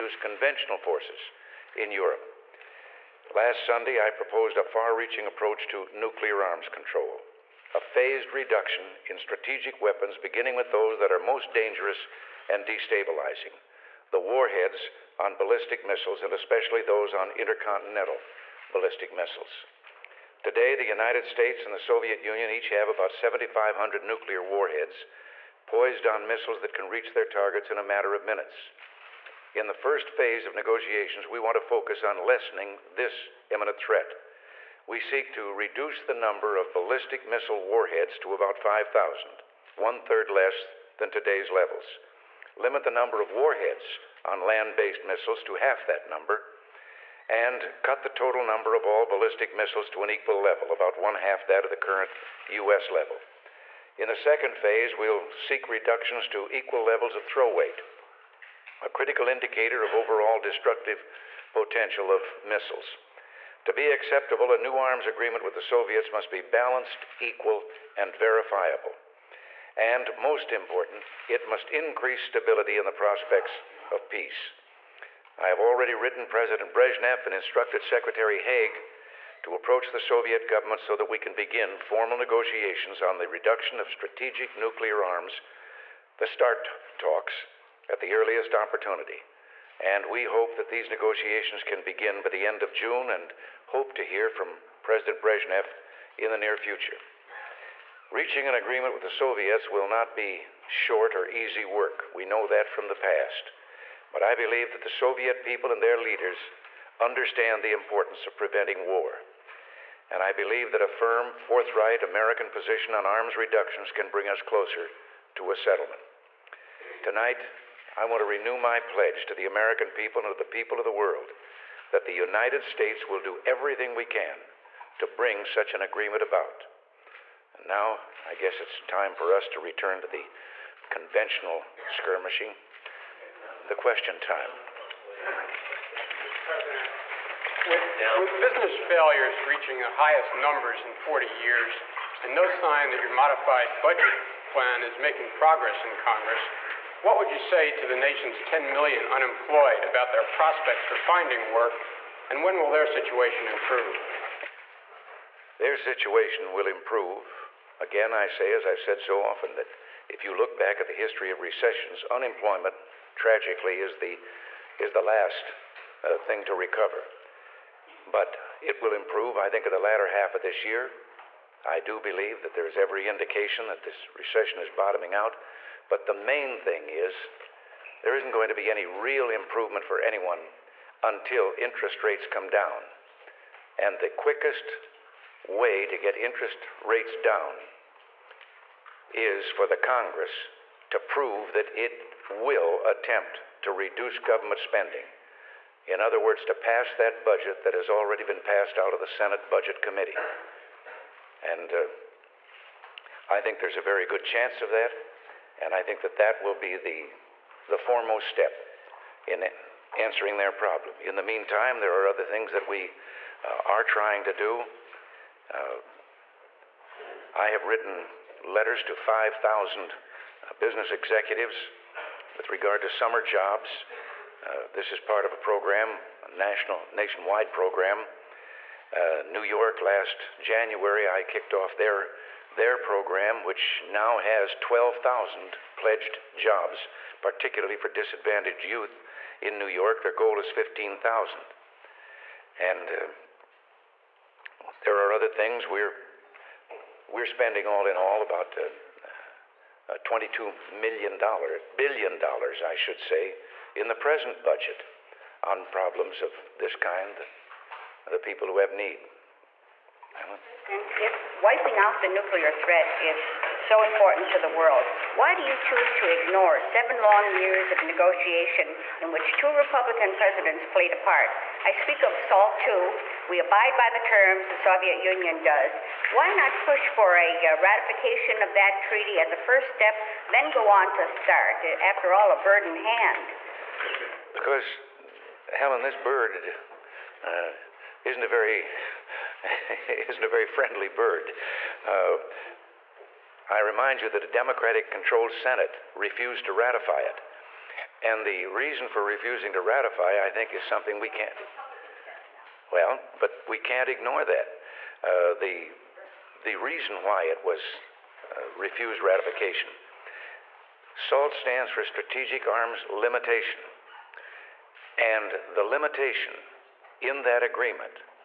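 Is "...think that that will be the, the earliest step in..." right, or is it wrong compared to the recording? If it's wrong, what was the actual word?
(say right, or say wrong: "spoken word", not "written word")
wrong: "foremost", not "earliest".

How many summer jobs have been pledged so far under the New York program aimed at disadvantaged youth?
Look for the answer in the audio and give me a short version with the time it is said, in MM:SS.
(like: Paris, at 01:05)
12,000, at 03:54.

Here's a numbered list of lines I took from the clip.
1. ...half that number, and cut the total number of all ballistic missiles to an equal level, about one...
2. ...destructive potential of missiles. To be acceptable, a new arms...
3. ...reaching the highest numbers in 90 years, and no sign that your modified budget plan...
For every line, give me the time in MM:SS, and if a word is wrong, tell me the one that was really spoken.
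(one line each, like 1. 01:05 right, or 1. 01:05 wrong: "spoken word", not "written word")
1. 00:45 right
2. 01:00 right
3. 02:19 wrong: "40", not "90".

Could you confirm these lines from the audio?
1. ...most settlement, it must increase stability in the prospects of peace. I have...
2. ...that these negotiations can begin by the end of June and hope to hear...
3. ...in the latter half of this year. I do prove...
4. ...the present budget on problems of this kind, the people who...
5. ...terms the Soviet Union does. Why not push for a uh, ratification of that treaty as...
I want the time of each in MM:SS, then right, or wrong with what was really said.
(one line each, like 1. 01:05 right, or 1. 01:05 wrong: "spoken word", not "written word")
1. 01:10 wrong: "important", not "settlement"
2. 01:30 right
3. 02:49 wrong: "believe", not "prove"
4. 04:13 right
5. 04:34 right.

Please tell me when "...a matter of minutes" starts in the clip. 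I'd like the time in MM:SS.
00:27.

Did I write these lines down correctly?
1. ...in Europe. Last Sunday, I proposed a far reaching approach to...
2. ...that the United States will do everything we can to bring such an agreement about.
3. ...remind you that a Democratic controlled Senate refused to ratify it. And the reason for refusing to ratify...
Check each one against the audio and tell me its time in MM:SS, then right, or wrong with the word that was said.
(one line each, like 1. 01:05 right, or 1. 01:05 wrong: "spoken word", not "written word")
1. 00:01 right
2. 02:01 right
3. 04:53 right.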